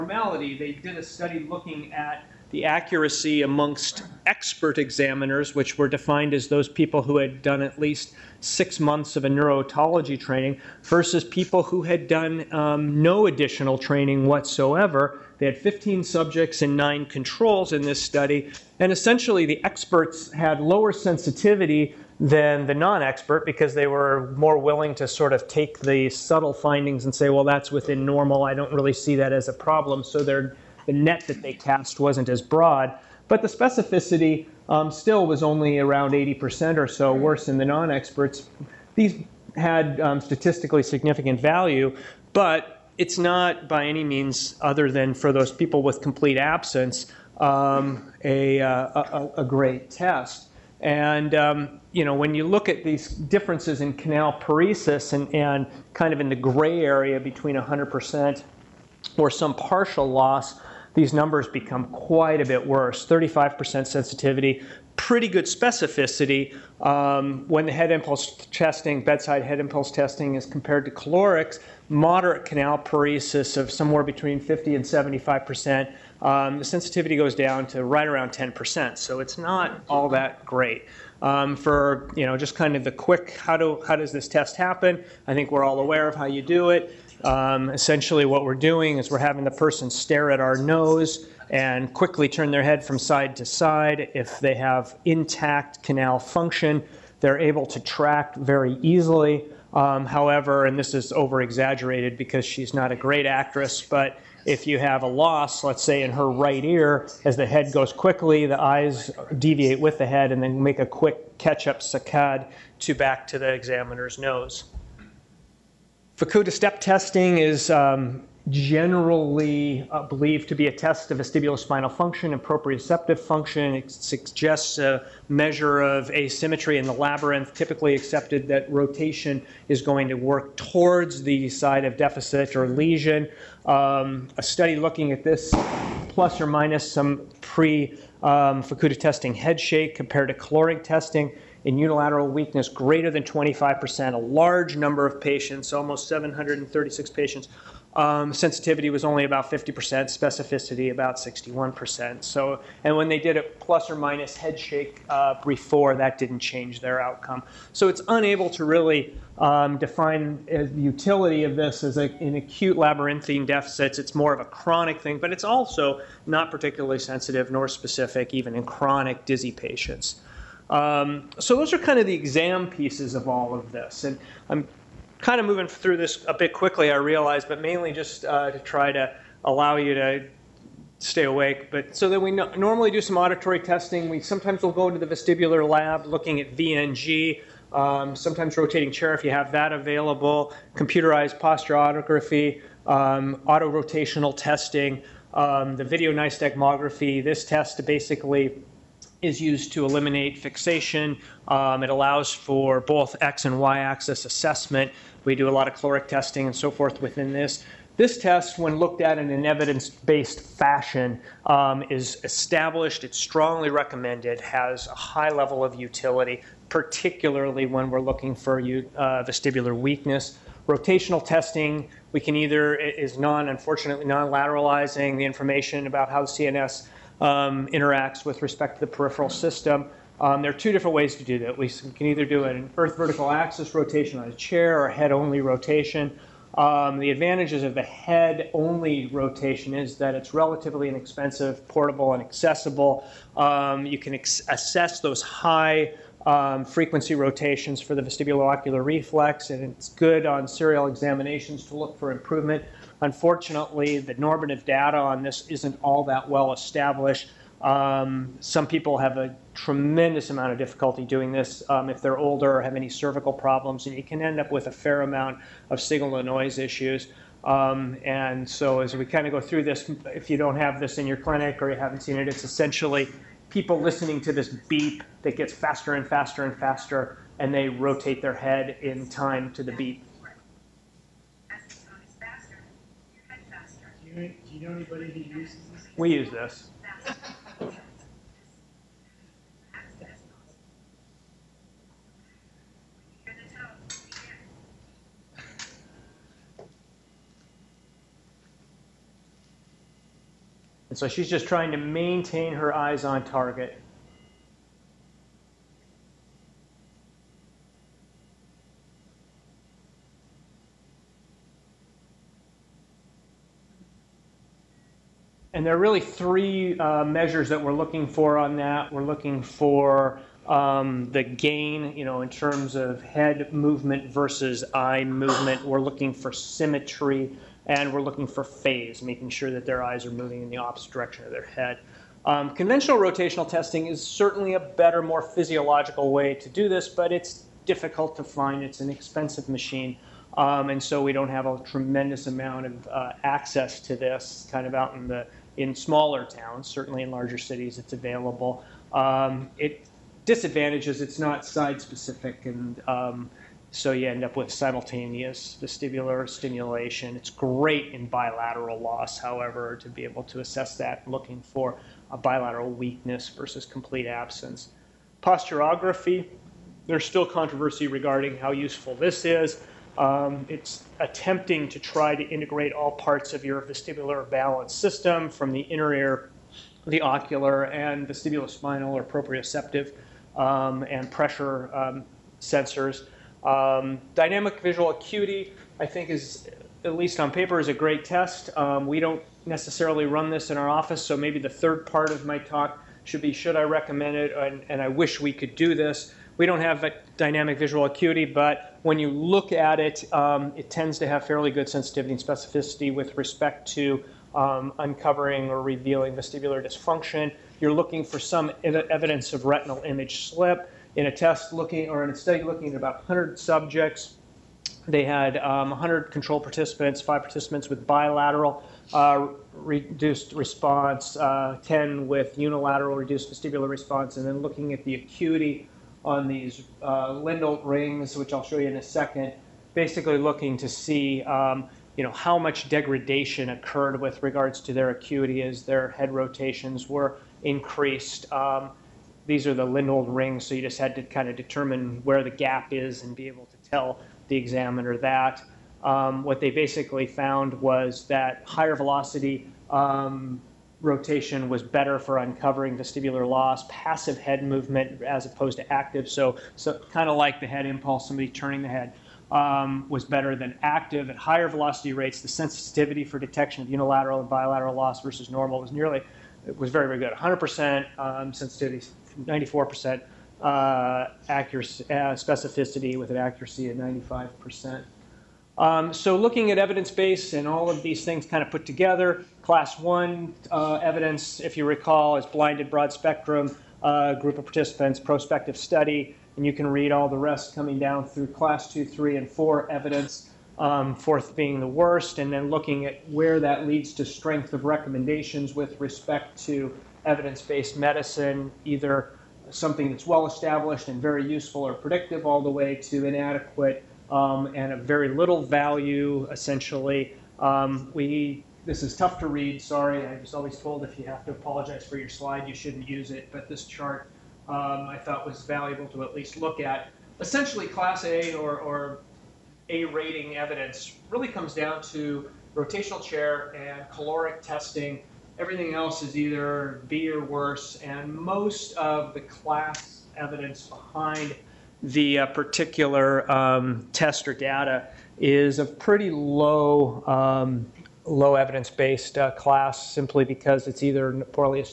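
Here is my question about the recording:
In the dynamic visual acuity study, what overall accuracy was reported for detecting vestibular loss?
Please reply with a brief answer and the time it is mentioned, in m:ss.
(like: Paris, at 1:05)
95%, at 7:53.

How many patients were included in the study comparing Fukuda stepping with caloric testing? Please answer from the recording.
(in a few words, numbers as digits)
736.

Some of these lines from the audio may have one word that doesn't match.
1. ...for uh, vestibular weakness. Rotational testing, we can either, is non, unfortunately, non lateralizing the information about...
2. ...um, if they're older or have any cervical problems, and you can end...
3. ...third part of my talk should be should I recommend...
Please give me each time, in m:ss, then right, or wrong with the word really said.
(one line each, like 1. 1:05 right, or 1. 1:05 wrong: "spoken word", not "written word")
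1. 3:38 right
2. 4:21 right
3. 6:31 right.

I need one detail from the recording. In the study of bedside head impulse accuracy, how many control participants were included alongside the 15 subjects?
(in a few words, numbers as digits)
9.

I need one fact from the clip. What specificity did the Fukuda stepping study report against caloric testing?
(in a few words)
61%.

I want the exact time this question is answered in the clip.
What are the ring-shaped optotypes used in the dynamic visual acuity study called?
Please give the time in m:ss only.
7:19.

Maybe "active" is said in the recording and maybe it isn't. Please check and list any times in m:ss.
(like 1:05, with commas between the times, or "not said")
7:35, 7:40.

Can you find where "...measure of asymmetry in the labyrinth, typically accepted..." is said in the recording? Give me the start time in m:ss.
2:05.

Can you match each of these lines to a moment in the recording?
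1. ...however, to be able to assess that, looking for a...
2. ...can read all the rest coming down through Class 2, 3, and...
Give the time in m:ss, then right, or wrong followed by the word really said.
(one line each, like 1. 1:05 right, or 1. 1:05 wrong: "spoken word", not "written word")
1. 5:59 right
2. 8:06 right.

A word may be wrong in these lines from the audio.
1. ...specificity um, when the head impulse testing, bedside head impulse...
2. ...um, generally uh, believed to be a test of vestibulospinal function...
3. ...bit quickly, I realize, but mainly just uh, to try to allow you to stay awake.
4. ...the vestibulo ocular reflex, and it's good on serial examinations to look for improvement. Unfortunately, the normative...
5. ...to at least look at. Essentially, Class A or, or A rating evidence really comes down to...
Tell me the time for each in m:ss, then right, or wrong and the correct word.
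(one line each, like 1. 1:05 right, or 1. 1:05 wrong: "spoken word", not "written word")
1. 1:05 right
2. 1:57 right
3. 2:56 right
4. 4:07 right
5. 8:35 right.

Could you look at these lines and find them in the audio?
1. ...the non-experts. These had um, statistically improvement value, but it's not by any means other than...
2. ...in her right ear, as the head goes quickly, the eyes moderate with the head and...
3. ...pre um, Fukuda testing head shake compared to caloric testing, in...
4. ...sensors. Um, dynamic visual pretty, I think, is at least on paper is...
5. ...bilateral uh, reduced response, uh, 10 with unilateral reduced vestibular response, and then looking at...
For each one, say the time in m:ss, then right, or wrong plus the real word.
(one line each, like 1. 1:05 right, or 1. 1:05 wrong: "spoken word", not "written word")
1. 0:37 wrong: "significant", not "improvement"
2. 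1:46 wrong: "deviate", not "moderate"
3. 2:17 right
4. 6:22 wrong: "acuity", not "pretty"
5. 6:57 right.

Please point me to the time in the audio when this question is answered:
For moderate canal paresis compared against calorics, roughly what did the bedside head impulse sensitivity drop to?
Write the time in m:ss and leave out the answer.
1:17.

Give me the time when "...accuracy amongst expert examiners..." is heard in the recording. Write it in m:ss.
0:02.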